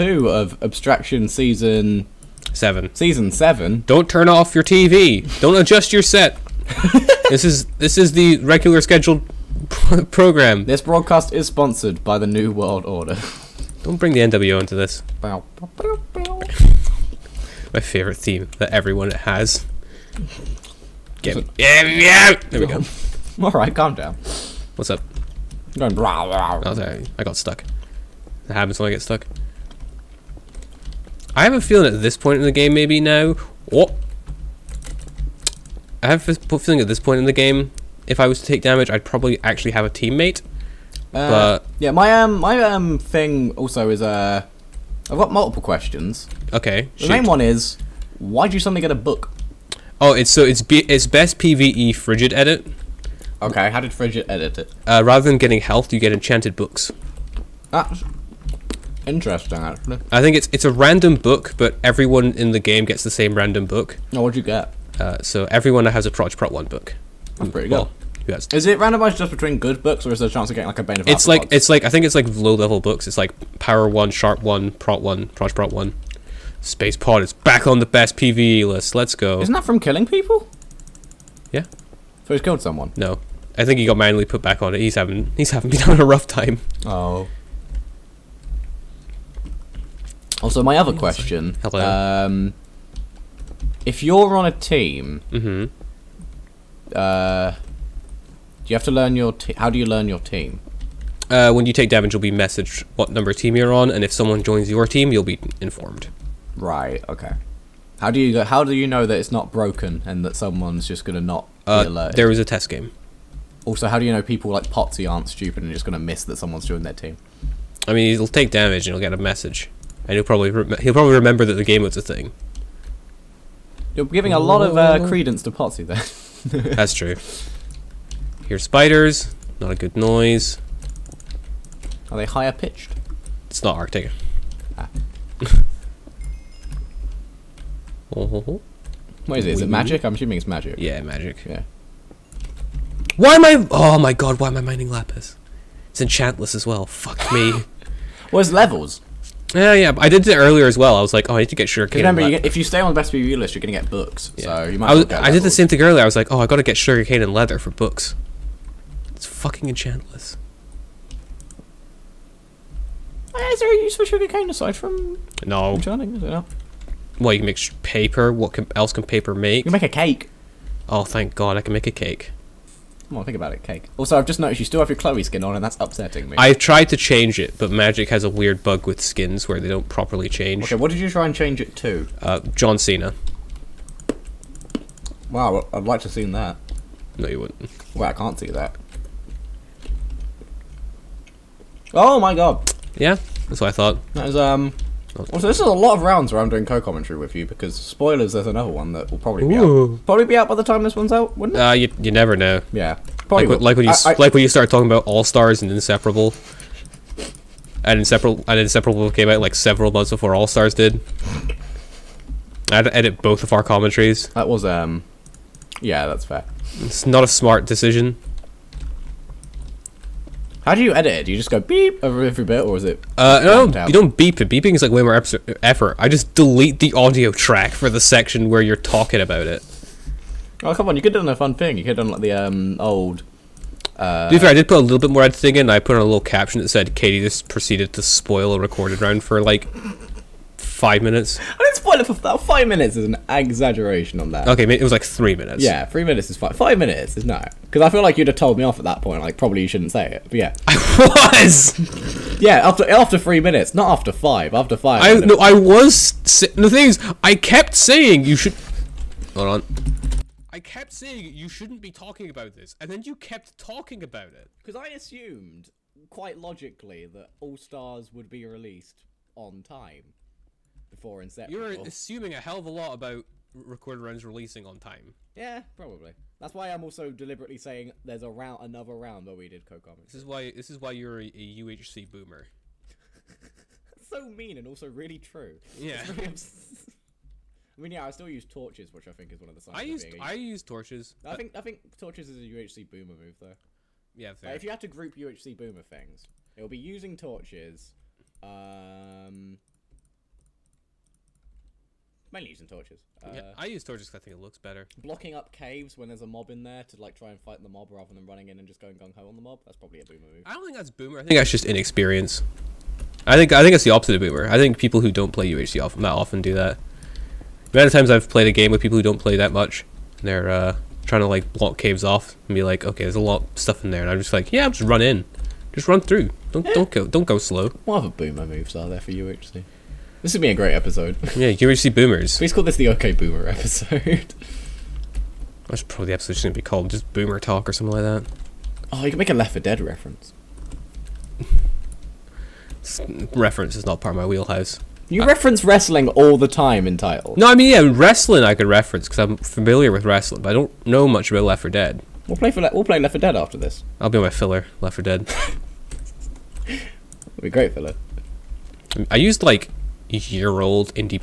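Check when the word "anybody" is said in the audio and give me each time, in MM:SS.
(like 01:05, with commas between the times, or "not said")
not said.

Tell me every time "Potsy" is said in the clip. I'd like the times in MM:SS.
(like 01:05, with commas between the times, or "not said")
01:54, 02:05.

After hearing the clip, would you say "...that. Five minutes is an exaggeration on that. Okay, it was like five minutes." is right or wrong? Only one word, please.
wrong.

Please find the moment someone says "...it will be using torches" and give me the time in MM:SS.
04:56.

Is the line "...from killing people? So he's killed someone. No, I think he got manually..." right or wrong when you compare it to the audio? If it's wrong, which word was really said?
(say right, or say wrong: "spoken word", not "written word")
right.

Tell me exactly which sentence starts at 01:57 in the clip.
I mean, he'll take damage and he'll get a message, and he'll probably he'll probably remember that the game was a thing.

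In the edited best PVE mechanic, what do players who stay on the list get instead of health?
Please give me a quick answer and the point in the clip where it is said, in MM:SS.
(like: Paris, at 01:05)
Enchanted books, at 00:56.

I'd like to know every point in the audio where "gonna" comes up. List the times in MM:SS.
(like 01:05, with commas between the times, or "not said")
01:51, 02:33.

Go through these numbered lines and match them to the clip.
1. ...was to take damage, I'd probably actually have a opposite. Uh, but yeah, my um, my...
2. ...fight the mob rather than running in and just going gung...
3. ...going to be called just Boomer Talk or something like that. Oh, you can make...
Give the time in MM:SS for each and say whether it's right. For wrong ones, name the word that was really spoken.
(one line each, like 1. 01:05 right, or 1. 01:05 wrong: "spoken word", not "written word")
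1. 00:38 wrong: "teammate", not "opposite"
2. 05:07 right
3. 05:36 right.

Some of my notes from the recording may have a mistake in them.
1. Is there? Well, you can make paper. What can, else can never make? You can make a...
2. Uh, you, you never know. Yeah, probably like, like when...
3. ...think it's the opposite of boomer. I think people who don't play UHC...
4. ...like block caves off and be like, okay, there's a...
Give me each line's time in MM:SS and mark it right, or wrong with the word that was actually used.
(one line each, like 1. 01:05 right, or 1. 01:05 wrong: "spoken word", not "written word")
1. 02:46 wrong: "paper", not "never"
2. 03:21 right
3. 05:13 right
4. 05:21 right.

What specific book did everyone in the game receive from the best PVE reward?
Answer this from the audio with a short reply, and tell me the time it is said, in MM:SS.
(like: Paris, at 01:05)
Proj Prot 1, at 01:06.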